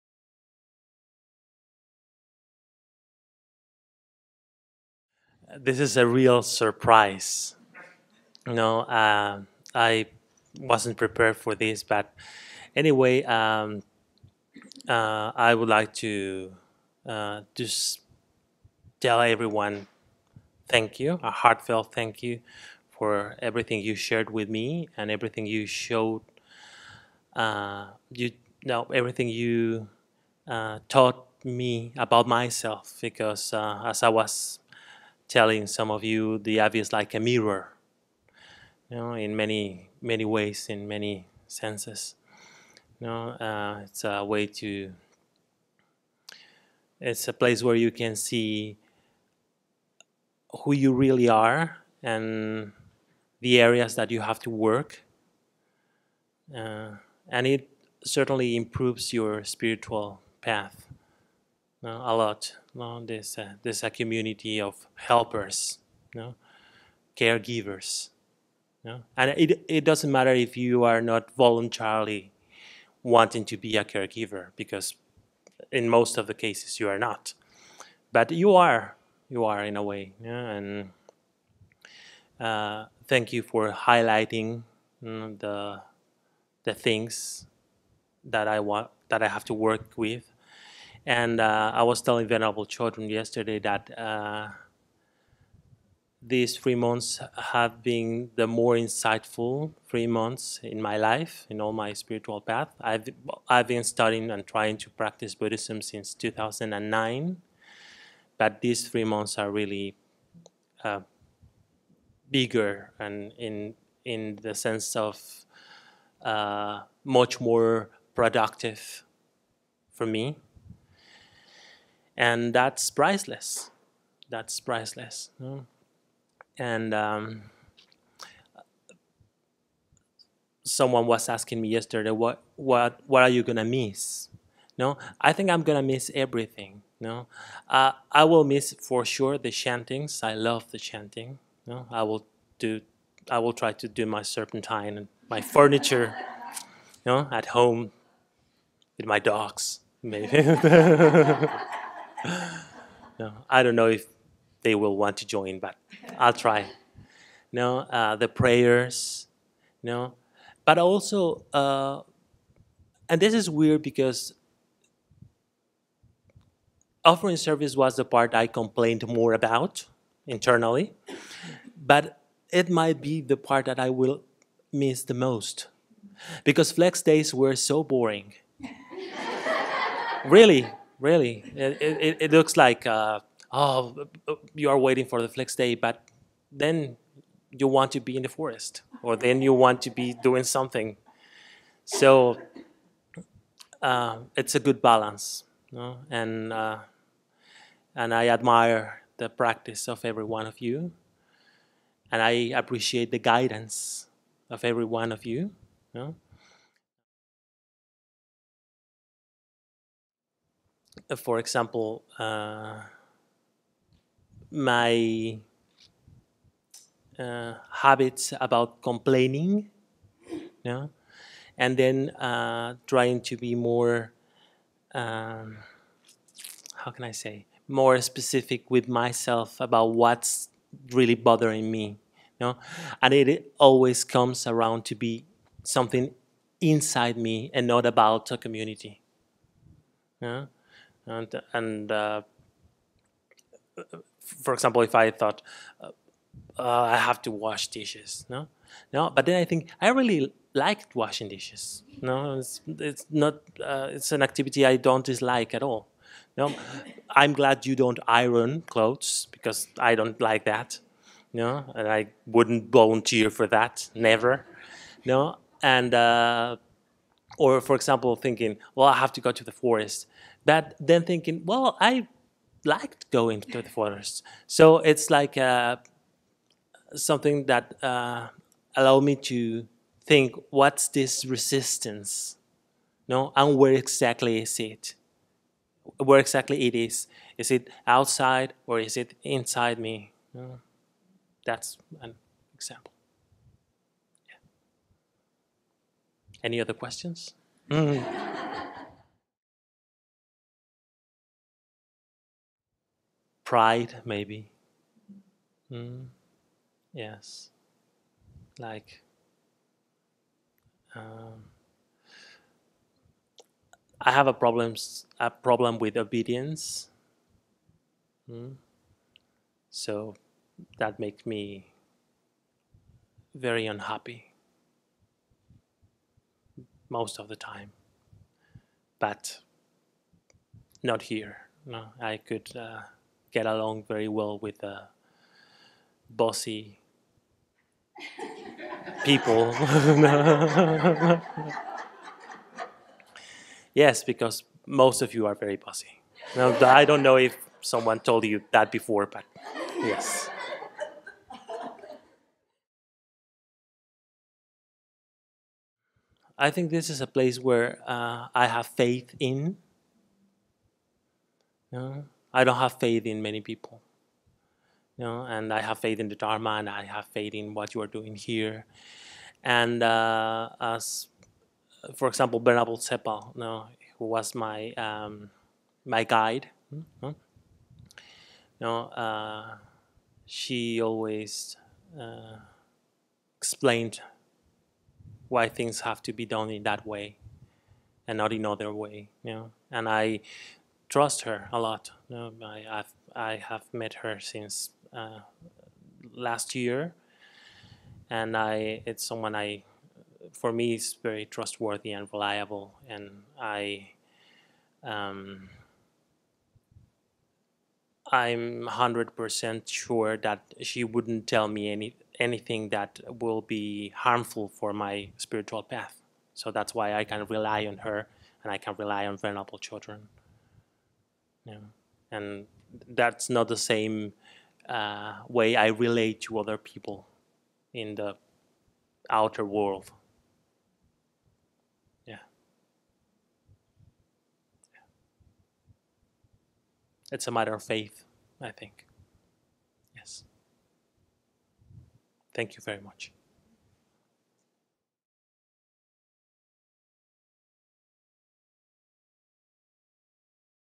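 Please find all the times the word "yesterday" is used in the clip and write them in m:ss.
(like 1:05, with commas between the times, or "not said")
1:33, 2:11.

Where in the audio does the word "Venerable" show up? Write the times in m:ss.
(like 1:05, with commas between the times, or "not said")
1:32, 6:59.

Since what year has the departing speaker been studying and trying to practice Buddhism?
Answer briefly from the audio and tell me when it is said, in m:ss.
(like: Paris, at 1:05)
2009, at 1:46.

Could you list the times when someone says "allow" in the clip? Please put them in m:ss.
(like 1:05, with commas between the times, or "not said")
4:38.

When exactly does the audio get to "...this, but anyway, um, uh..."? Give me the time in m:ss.
0:11.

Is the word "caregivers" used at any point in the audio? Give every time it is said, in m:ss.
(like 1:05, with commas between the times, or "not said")
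1:07, 1:13.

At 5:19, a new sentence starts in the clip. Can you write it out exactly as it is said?
So that makes me very unhappy most of the time.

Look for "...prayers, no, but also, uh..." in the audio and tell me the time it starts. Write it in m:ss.
2:38.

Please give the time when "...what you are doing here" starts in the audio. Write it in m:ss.
6:07.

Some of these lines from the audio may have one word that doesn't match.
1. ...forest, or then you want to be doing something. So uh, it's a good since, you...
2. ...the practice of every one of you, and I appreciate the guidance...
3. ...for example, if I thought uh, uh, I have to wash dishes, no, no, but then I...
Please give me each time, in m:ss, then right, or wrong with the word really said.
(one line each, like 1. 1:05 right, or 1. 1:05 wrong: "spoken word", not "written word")
1. 3:08 wrong: "balance", not "since"
2. 3:19 right
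3. 4:04 right.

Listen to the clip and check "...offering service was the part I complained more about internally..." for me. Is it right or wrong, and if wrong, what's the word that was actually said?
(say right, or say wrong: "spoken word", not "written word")
right.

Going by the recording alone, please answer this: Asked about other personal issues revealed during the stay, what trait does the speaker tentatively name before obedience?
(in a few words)
Pride.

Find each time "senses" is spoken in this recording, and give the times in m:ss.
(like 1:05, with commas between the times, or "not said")
0:41, 1:54.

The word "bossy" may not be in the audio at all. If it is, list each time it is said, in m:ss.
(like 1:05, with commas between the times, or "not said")
5:36, 5:45.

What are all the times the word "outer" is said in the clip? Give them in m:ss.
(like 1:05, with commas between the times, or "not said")
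7:09.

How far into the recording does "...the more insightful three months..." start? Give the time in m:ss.
1:38.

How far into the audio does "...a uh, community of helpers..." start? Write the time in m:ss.
1:03.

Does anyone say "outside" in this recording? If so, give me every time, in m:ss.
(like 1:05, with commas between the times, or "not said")
4:47.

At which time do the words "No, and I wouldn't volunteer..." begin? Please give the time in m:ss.
4:21.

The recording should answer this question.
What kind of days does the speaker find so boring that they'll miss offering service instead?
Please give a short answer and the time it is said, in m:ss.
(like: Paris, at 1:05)
flex days, at 2:56.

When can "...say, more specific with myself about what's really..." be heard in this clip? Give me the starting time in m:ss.
3:47.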